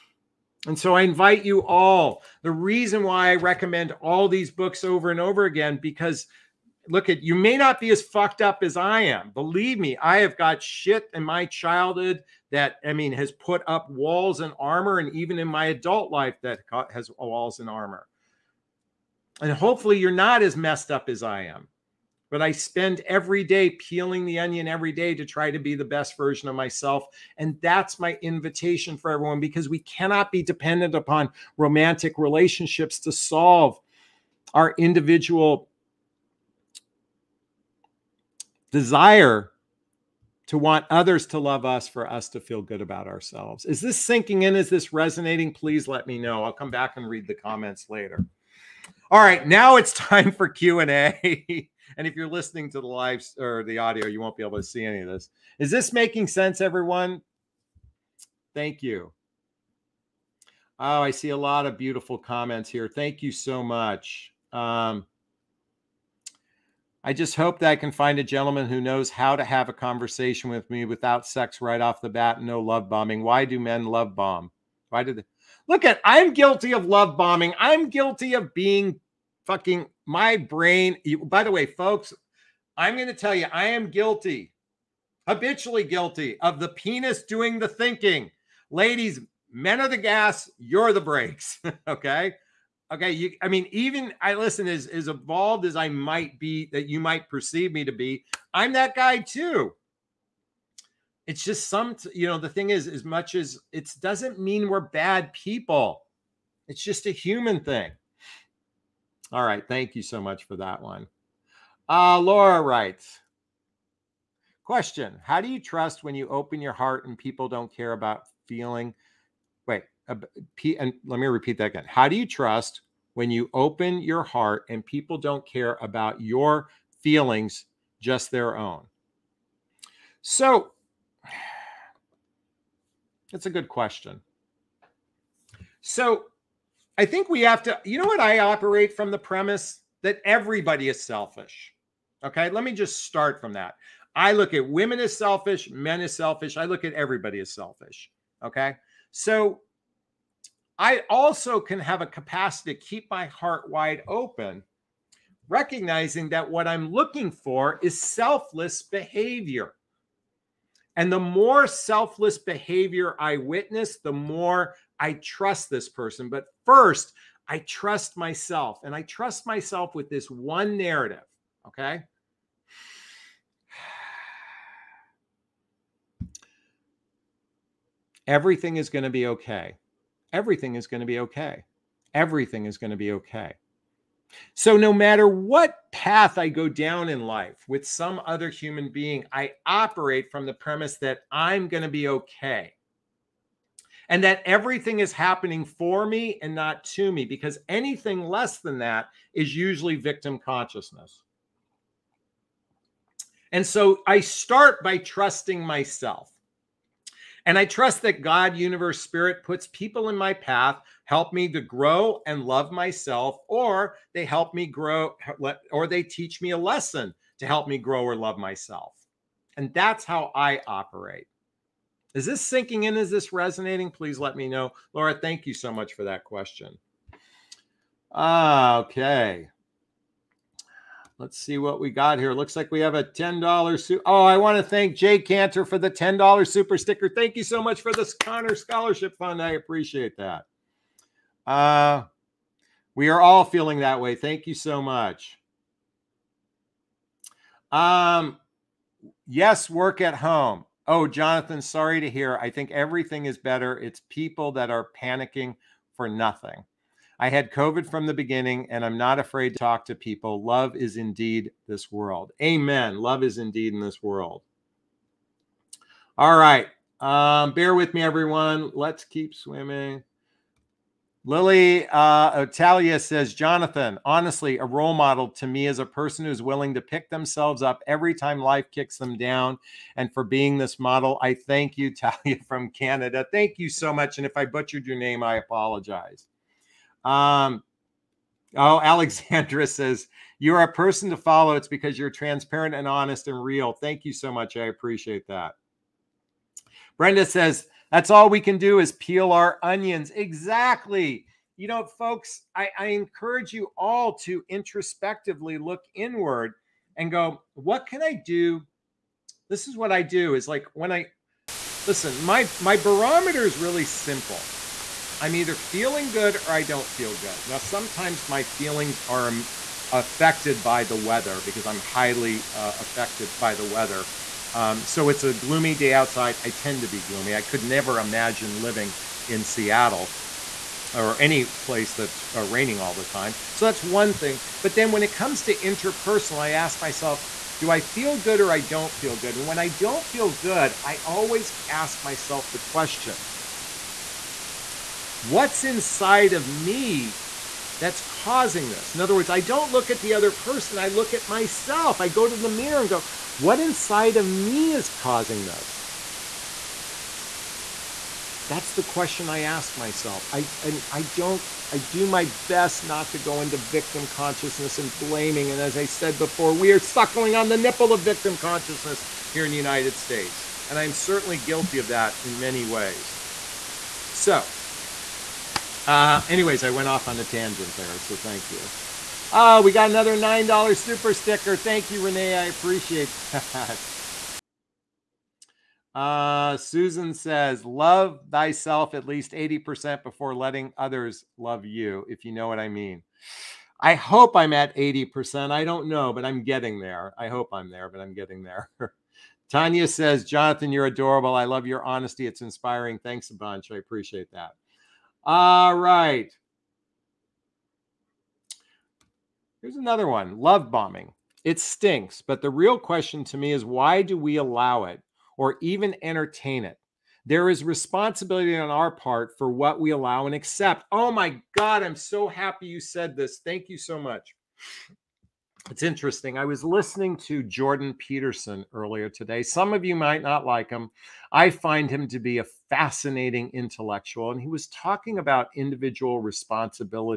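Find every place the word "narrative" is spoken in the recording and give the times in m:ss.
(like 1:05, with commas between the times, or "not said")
2:50.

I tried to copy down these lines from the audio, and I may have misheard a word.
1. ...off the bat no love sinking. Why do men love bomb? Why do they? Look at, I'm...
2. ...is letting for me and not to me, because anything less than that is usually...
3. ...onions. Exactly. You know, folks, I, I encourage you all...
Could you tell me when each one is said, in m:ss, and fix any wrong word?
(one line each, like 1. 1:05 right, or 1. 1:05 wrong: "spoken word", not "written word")
1. 1:11 wrong: "bombing", not "sinking"
2. 3:14 wrong: "happening", not "letting"
3. 4:59 right.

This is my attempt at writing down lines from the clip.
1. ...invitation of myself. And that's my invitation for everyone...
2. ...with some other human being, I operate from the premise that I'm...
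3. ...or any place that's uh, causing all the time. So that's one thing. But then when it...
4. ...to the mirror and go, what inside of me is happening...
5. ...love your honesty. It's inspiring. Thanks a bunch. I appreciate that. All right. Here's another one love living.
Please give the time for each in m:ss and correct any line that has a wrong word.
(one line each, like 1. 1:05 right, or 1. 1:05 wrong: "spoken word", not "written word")
1. 0:26 wrong: "version", not "invitation"
2. 3:07 right
3. 5:30 wrong: "raining", not "causing"
4. 5:52 wrong: "causing", not "happening"
5. 6:41 wrong: "bombing", not "living".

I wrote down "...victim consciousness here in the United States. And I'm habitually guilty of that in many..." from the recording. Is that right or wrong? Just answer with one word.
wrong.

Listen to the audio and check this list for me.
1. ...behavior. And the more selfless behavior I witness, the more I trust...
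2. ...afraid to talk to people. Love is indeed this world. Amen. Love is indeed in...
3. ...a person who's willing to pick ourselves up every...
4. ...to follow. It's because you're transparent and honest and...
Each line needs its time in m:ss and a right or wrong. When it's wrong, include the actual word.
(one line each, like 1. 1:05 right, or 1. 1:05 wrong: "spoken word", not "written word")
1. 2:38 right
2. 4:19 right
3. 4:35 wrong: "themselves", not "ourselves"
4. 4:51 right.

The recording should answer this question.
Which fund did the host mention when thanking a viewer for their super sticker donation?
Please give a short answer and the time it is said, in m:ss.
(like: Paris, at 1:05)
Connor Scholarship Fund, at 3:58.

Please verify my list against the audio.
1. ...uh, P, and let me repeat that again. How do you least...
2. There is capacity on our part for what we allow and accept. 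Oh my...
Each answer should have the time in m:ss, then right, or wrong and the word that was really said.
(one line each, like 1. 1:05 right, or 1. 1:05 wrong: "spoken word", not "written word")
1. 2:00 wrong: "trust", not "least"
2. 6:57 wrong: "responsibility", not "capacity".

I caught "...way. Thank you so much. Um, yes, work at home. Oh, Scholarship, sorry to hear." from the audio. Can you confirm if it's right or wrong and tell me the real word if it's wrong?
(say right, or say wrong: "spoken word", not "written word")
wrong: "Jonathon", not "Scholarship".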